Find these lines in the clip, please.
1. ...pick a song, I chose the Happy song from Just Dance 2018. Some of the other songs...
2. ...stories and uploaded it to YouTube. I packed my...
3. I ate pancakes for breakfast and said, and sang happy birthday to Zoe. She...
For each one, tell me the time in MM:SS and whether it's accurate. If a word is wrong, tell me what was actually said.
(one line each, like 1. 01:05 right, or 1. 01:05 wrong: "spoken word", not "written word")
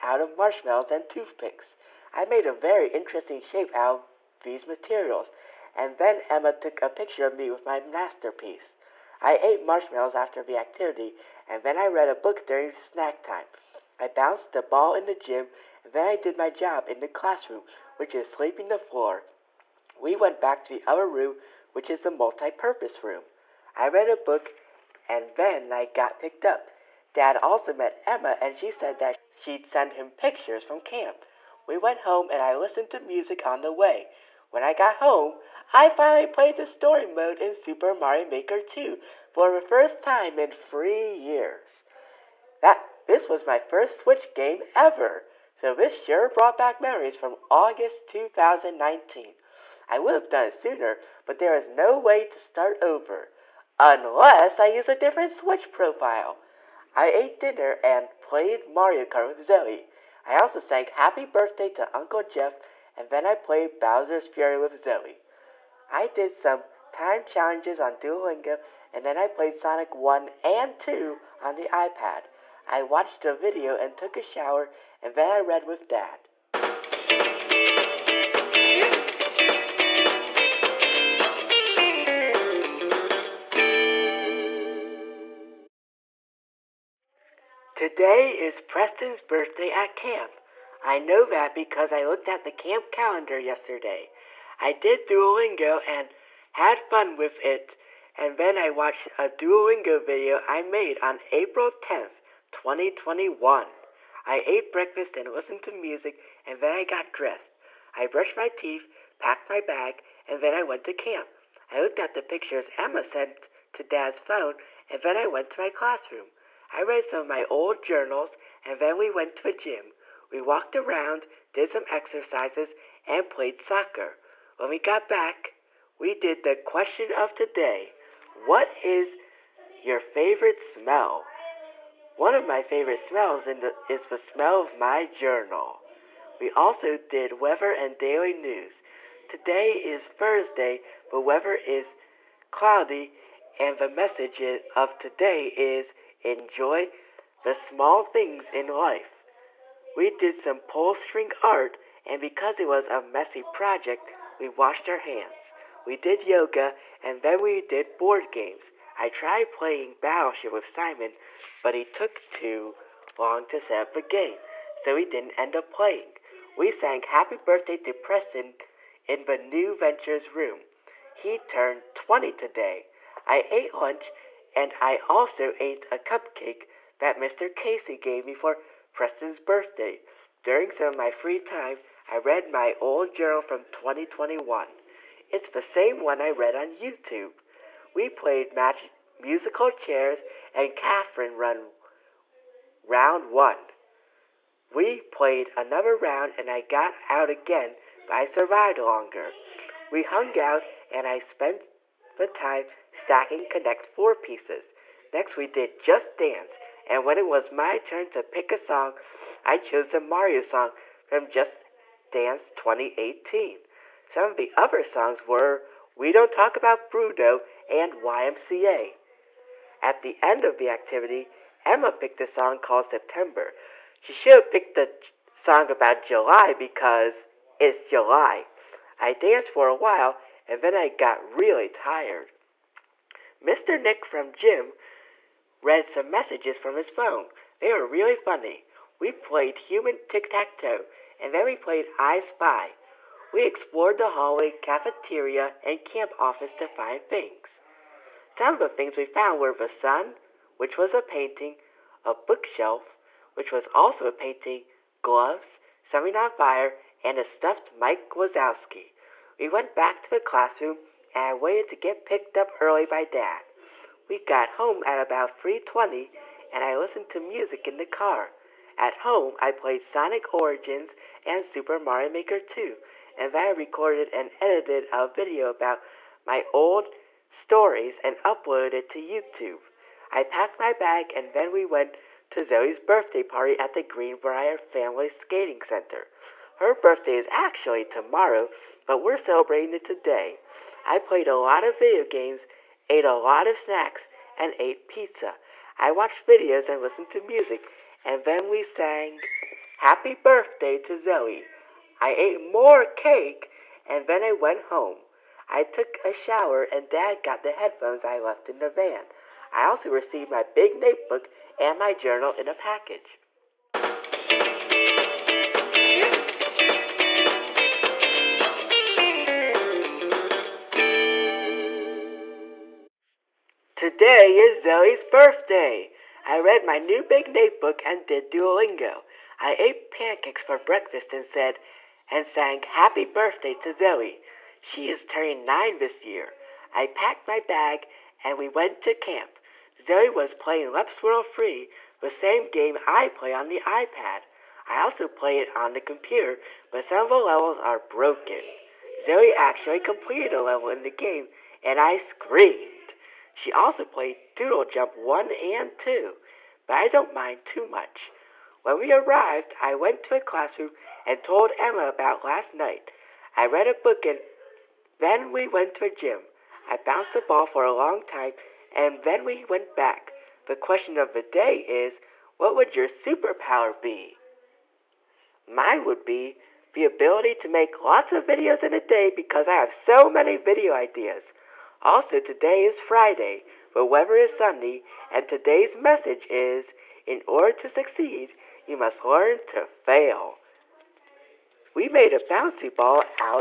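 1. 03:28 wrong: "Mario", not "Happy"
2. 04:37 right
3. 05:29 right.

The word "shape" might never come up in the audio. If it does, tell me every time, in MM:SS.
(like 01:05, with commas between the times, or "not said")
00:03.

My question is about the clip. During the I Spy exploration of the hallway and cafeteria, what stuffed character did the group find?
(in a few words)
Mike Wazowski.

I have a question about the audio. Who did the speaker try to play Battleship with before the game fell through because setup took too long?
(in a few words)
Simon.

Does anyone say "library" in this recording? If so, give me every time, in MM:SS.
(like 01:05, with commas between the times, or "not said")
not said.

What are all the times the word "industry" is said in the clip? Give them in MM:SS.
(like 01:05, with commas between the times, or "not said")
not said.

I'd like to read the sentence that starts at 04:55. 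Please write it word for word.
I watched videos and listened to music, and then we sang Happy Birthday to Zoe.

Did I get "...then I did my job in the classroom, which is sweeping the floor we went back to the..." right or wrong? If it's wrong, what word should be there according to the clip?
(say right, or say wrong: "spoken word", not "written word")
right.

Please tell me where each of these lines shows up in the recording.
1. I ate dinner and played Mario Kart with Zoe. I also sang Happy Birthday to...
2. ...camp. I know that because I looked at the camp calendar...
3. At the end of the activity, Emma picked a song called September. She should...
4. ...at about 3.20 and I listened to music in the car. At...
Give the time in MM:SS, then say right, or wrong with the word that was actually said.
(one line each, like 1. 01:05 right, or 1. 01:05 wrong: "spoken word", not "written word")
1. 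00:56 right
2. 01:29 right
3. 03:39 right
4. 04:24 right.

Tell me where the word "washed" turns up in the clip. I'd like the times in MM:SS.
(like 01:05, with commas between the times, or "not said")
02:34.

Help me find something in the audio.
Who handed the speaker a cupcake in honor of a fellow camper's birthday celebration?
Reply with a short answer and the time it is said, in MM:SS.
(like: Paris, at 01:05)
Mr. Casey, at 02:57.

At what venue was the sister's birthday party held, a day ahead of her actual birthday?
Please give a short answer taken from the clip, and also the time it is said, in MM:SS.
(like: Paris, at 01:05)
Greenbrier Family Skating Center, at 04:43.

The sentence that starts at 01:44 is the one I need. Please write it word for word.
I ate breakfast and listened to music, and then I got dressed.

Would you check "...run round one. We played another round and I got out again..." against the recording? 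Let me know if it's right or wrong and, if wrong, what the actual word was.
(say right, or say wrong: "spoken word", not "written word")
right.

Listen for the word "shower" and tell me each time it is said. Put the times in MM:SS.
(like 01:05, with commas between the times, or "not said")
01:14, 05:06.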